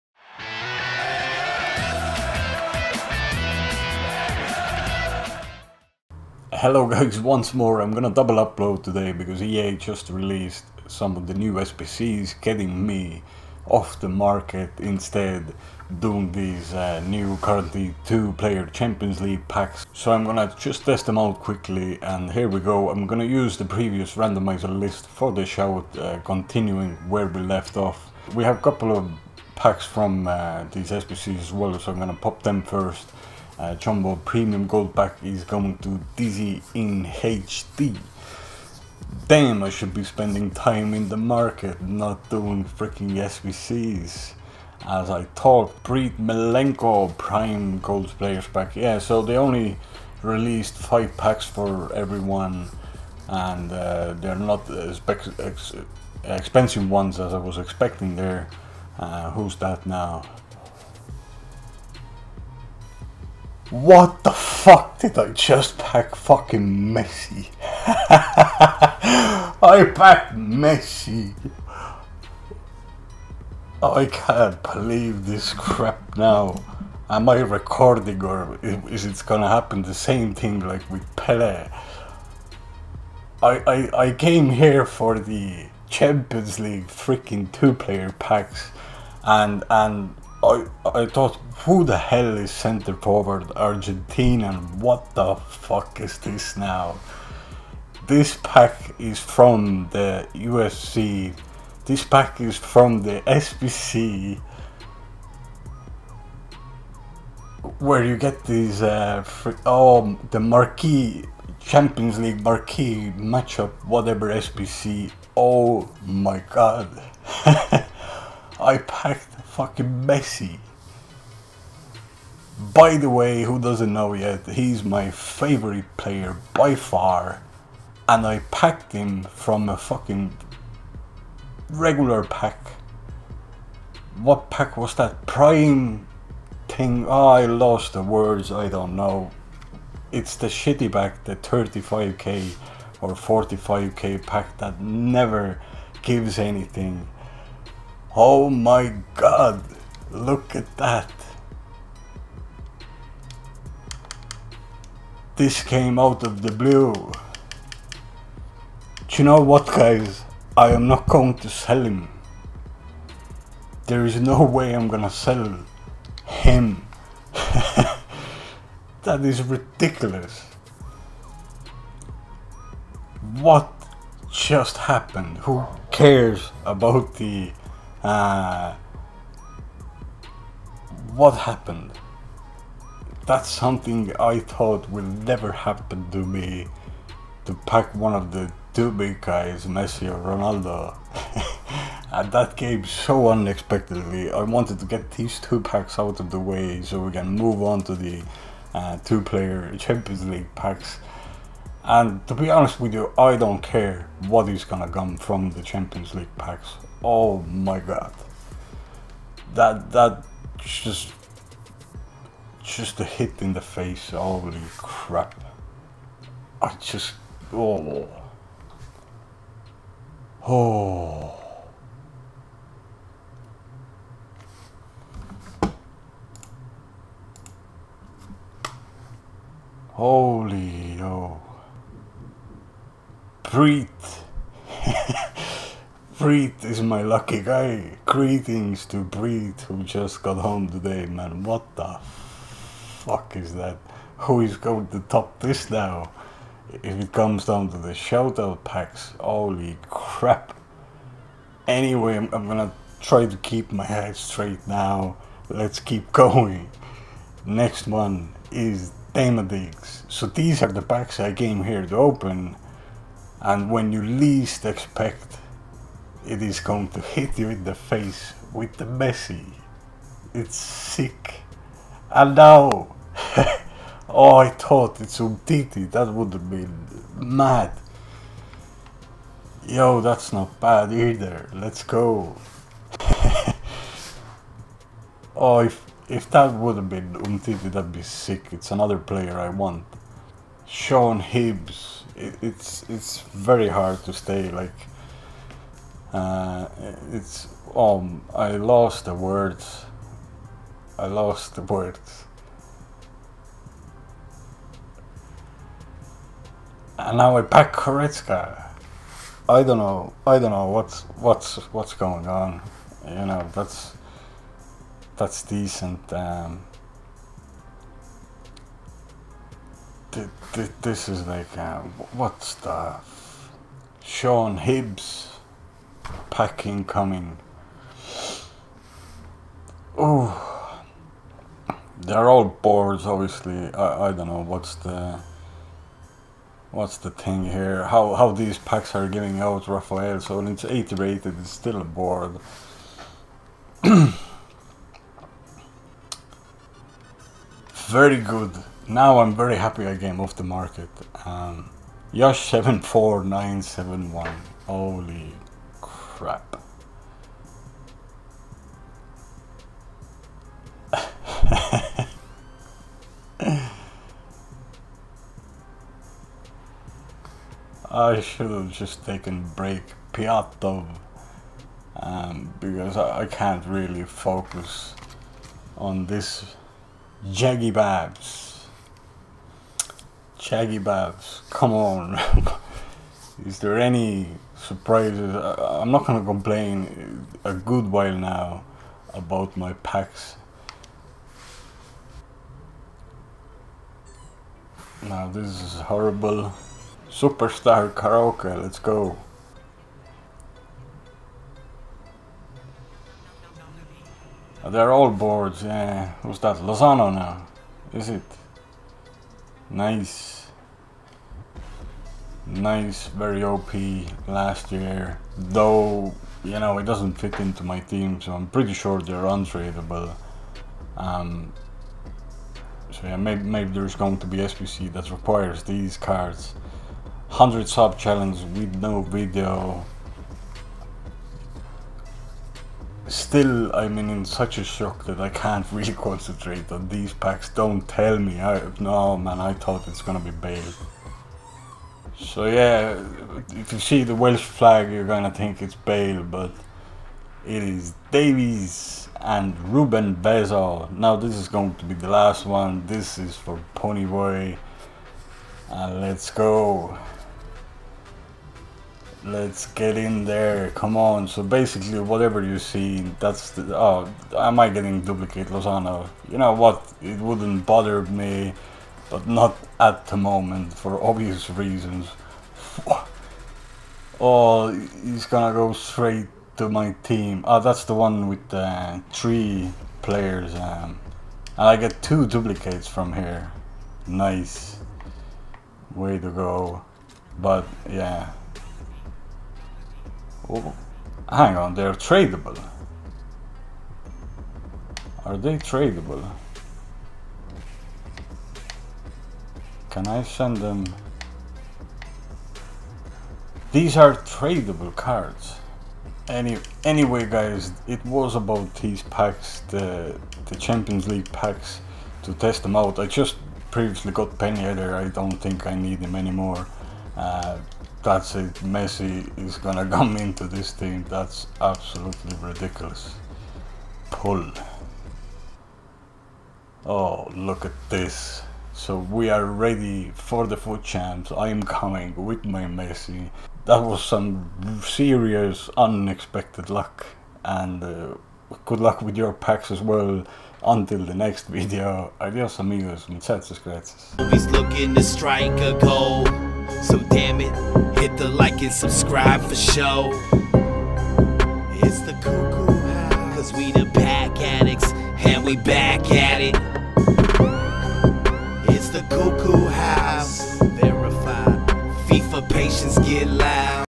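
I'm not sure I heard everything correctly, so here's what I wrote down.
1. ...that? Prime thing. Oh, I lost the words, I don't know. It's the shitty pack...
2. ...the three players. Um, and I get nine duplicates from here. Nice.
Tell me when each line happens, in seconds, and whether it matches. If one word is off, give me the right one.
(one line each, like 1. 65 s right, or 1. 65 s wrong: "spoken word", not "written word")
1. 134 s right
2. 478 s wrong: "two", not "nine".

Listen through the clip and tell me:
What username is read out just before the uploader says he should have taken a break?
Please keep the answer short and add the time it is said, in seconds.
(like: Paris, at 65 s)
Yosh 74971, at 352 s.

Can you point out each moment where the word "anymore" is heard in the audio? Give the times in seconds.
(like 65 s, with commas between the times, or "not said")
516 s.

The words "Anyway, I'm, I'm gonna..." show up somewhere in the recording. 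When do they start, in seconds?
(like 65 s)
251 s.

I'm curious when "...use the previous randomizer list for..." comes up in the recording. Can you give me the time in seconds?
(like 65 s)
23 s.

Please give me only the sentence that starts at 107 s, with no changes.
Where you get these, uh, oh, the marquee, Champions League marquee matchup, whatever SBC.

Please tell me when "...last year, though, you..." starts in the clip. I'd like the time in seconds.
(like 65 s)
414 s.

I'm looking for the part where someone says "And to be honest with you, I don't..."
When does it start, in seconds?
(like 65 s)
201 s.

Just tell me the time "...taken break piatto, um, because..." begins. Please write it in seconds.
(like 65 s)
369 s.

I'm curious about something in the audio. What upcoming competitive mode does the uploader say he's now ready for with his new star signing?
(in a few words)
FUT champs.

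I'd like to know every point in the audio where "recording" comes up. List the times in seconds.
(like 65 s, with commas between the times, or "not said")
77 s.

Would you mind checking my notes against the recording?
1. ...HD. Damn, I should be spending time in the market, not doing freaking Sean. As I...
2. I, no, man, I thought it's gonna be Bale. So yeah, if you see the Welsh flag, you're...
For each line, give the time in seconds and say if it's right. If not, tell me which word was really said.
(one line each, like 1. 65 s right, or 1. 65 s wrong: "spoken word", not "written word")
1. 37 s wrong: "SBCs", not "Sean"
2. 438 s right.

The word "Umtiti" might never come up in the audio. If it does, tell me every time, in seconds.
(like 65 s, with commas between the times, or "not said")
275 s, 287 s.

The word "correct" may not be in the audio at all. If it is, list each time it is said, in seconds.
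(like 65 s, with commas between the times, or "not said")
not said.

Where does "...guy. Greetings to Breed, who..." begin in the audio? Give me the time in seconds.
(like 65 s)
237 s.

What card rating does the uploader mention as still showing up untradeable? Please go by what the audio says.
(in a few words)
80.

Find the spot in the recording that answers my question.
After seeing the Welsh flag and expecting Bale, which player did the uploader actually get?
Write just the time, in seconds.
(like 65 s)
448 s.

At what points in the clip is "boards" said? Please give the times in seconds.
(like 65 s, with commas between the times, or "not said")
332 s, 341 s, 405 s.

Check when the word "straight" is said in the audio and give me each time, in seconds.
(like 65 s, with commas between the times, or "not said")
254 s, 475 s.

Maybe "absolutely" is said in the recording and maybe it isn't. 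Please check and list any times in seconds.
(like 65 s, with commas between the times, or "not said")
521 s.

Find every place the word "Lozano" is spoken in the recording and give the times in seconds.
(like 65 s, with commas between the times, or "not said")
406 s, 465 s.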